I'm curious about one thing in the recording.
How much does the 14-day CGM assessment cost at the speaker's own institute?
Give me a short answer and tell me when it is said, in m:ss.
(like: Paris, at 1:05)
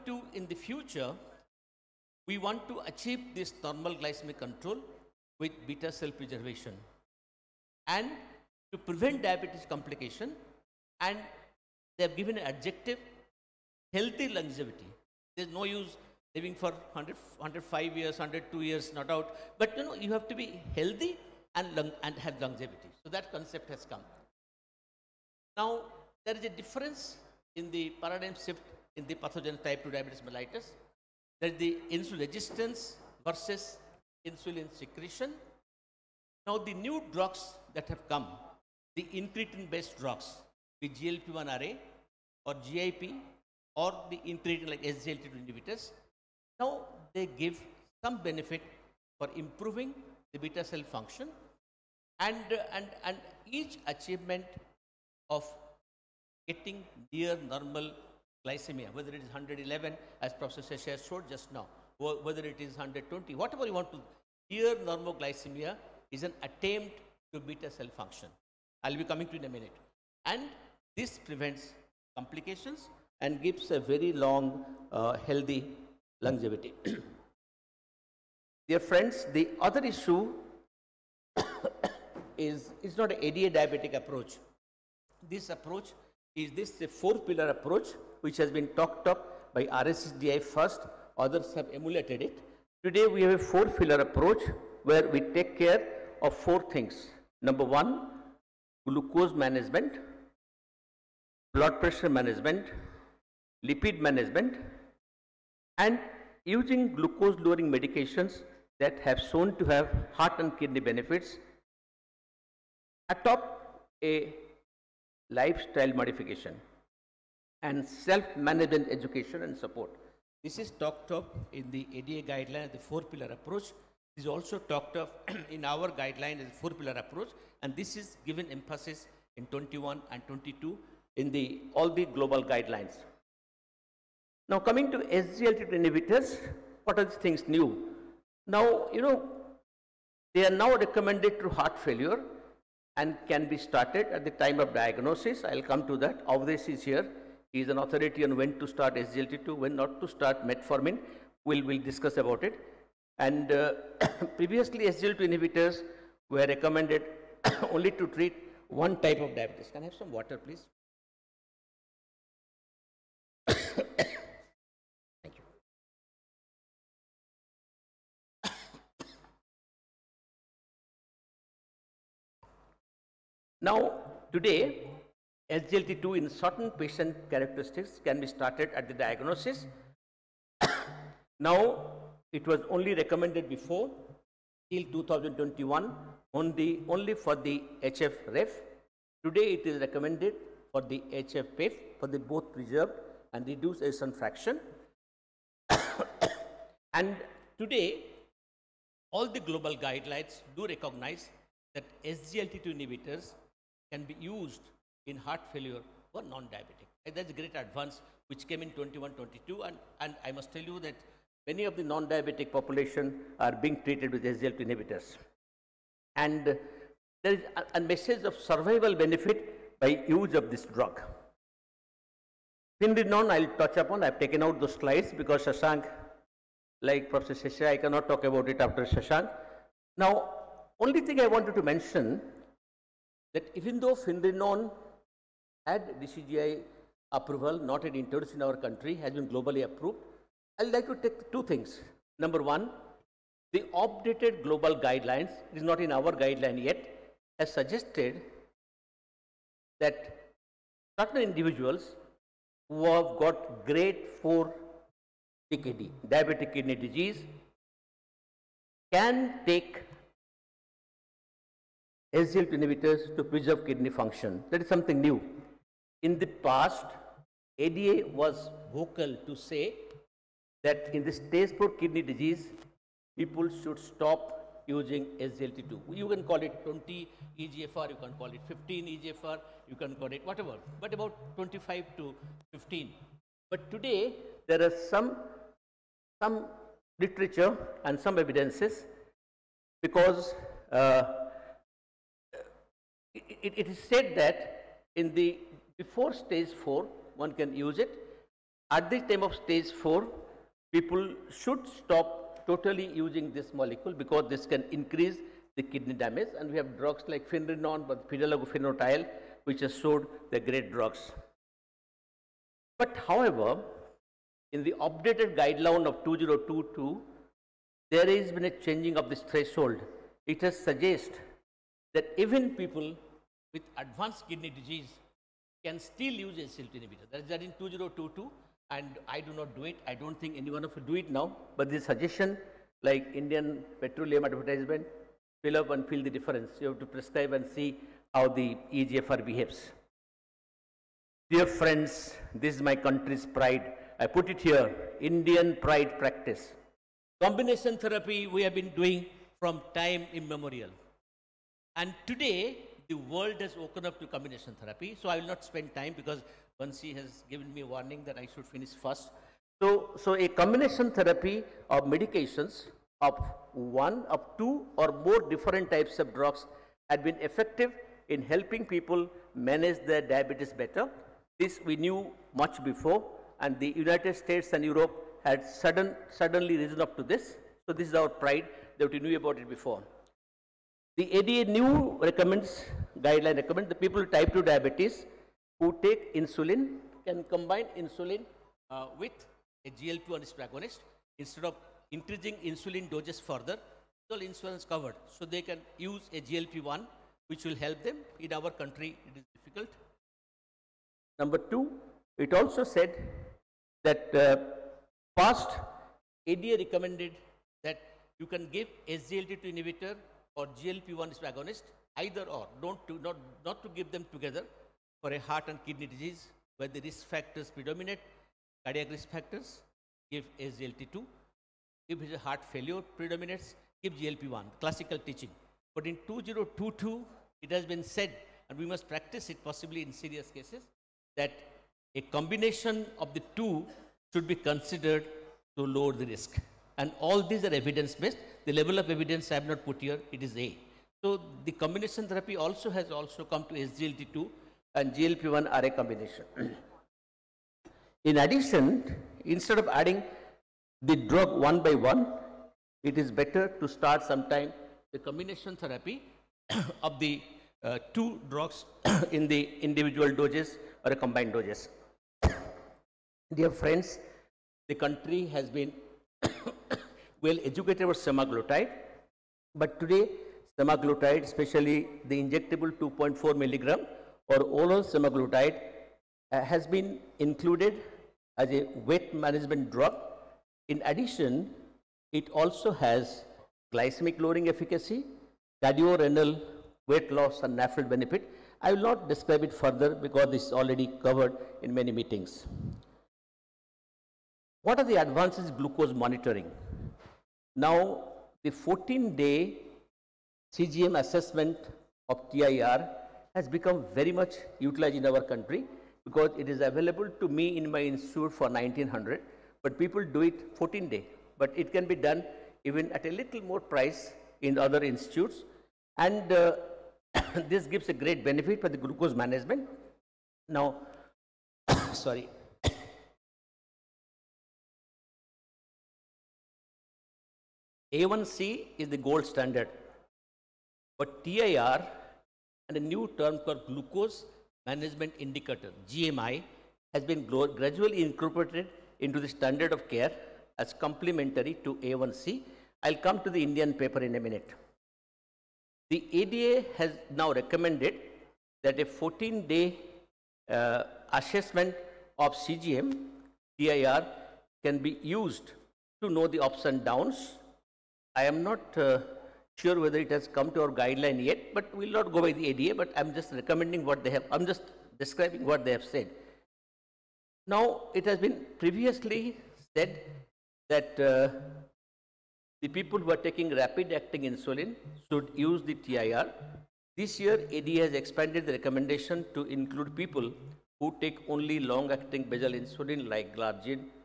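1900, at 8:28.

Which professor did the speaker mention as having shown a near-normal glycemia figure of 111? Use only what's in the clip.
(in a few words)
Professor Shah.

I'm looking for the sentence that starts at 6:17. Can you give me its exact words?
So this is our pride that we knew about it before.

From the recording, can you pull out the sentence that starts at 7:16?
And all these are evidence based.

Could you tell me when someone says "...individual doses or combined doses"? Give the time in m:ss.
7:39.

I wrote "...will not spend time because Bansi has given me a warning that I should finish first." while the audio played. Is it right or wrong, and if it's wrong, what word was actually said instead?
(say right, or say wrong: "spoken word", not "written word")
right.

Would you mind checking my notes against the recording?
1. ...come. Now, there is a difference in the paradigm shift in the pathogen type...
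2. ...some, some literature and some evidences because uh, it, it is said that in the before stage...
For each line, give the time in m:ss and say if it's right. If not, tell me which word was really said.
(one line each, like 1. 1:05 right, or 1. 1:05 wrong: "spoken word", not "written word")
1. 0:23 right
2. 4:44 right.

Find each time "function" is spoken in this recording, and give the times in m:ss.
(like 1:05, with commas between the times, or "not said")
0:50, 1:07, 4:23.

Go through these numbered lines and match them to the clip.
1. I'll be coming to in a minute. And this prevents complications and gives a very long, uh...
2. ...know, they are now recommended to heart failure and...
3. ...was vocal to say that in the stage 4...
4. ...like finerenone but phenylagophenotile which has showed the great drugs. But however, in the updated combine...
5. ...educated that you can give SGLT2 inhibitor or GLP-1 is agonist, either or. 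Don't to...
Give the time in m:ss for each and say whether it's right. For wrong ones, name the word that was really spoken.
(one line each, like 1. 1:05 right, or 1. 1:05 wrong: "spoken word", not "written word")
1. 1:08 right
2. 2:19 right
3. 4:28 right
4. 5:07 wrong: "guideline", not "combine"
5. 6:46 wrong: "recommended", not "educated".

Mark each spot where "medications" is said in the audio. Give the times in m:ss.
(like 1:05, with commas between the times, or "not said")
1:47, 6:01.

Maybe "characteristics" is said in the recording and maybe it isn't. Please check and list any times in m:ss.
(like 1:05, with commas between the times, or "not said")
2:57.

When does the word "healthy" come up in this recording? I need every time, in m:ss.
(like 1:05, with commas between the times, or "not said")
0:13, 0:20, 1:15.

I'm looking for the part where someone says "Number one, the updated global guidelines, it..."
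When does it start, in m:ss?
4:02.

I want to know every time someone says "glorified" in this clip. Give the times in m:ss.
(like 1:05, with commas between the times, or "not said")
not said.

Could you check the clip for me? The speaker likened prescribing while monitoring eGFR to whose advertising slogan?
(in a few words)
Indian petroleum.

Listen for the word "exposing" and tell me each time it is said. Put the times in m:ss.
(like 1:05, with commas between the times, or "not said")
not said.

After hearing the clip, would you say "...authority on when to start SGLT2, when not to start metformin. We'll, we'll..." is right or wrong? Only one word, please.
right.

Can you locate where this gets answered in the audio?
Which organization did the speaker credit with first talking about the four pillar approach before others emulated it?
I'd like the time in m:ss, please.
1:29.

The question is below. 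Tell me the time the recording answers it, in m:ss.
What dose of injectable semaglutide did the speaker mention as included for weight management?
7:52.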